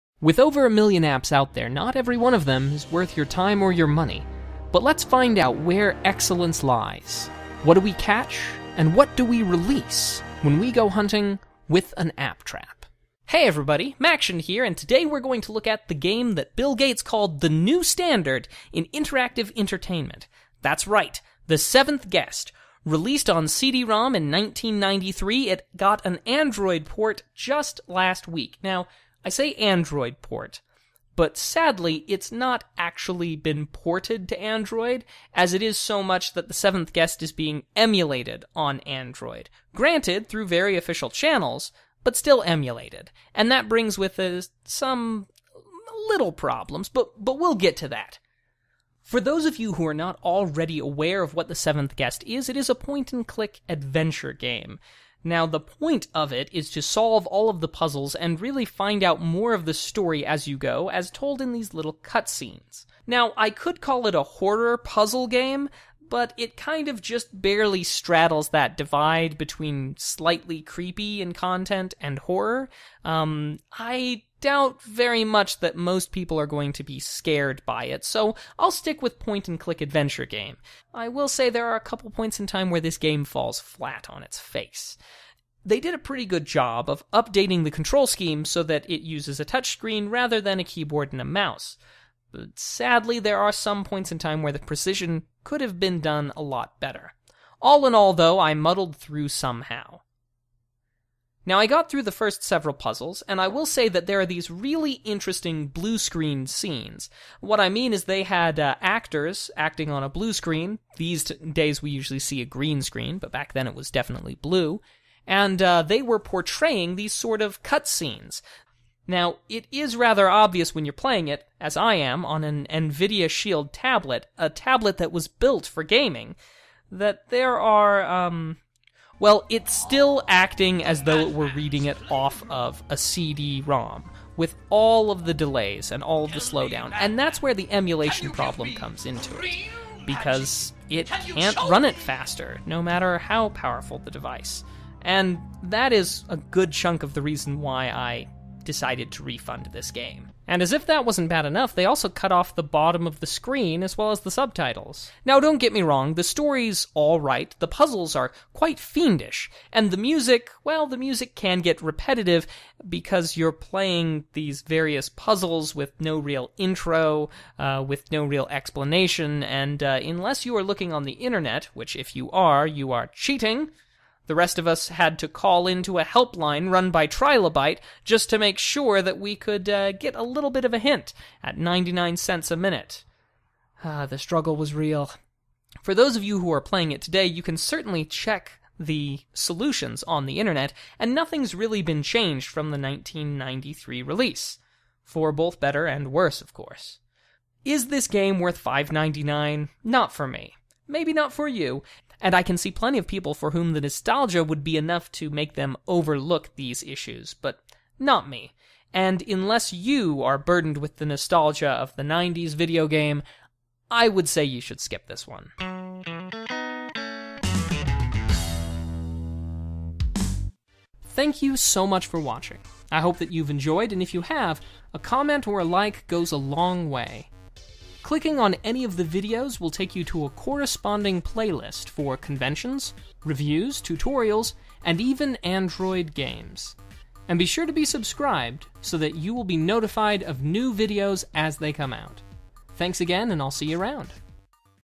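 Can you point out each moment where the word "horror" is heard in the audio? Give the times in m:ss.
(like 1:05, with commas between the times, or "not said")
1:04, 1:12.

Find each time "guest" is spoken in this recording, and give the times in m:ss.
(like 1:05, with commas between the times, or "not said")
0:22, 0:36, 0:51.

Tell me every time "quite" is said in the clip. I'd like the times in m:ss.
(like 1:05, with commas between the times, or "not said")
2:38.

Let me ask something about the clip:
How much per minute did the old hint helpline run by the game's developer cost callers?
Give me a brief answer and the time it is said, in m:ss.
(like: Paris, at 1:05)
99 cents, at 3:01.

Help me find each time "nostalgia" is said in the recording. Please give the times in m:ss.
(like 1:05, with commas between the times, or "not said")
3:23, 3:31.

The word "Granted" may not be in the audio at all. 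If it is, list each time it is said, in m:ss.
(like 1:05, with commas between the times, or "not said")
0:39.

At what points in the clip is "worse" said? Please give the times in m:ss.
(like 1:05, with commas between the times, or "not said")
3:16.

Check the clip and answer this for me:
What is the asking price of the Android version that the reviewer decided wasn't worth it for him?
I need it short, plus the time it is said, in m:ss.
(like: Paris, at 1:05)
$5.99, at 3:18.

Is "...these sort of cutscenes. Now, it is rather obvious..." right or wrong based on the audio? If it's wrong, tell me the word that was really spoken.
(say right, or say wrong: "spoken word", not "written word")
right.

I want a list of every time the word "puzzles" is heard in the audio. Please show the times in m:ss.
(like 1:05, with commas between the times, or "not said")
0:57, 1:04, 1:42, 2:37, 2:45.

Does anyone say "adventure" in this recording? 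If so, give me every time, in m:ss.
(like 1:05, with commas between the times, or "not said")
0:53, 1:19.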